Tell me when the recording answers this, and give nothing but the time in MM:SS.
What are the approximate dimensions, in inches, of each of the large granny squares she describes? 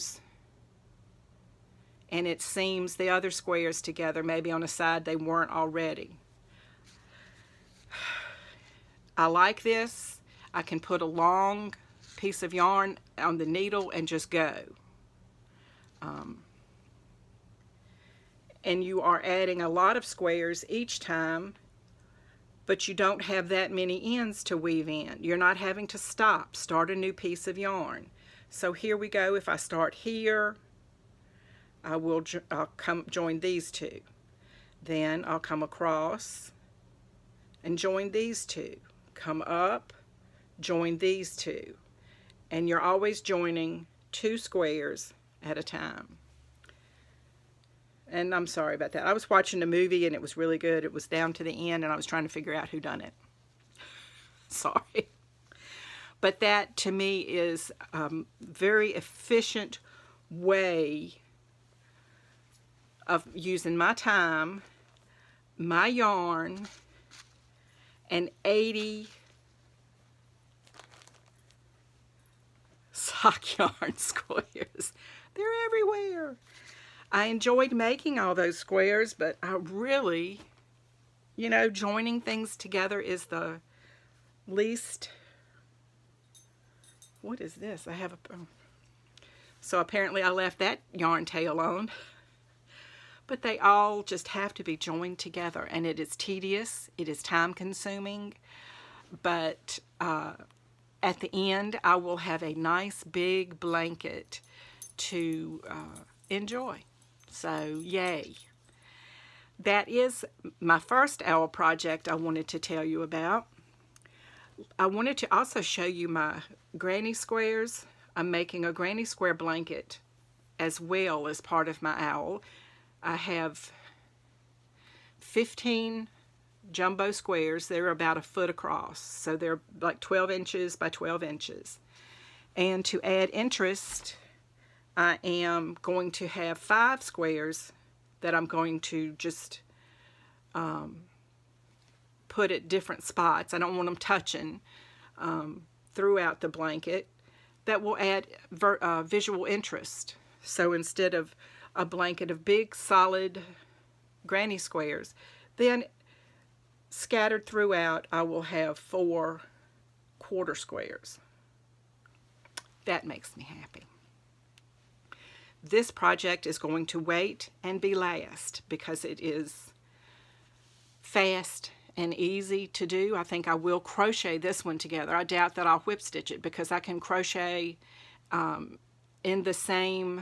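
02:10.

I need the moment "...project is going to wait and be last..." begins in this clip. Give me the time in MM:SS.
02:45.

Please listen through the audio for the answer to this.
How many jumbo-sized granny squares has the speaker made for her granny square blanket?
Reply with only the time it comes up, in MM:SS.
02:05.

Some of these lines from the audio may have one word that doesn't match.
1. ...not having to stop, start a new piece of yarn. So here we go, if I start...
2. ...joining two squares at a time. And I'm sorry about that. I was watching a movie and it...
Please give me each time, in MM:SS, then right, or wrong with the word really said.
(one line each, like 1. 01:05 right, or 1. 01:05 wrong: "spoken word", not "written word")
1. 00:25 right
2. 00:43 right.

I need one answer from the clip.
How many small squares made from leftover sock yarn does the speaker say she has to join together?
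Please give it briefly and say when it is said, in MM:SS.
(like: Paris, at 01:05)
80, at 01:08.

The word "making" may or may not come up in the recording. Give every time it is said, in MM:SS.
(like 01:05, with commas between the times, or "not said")
01:17, 01:58.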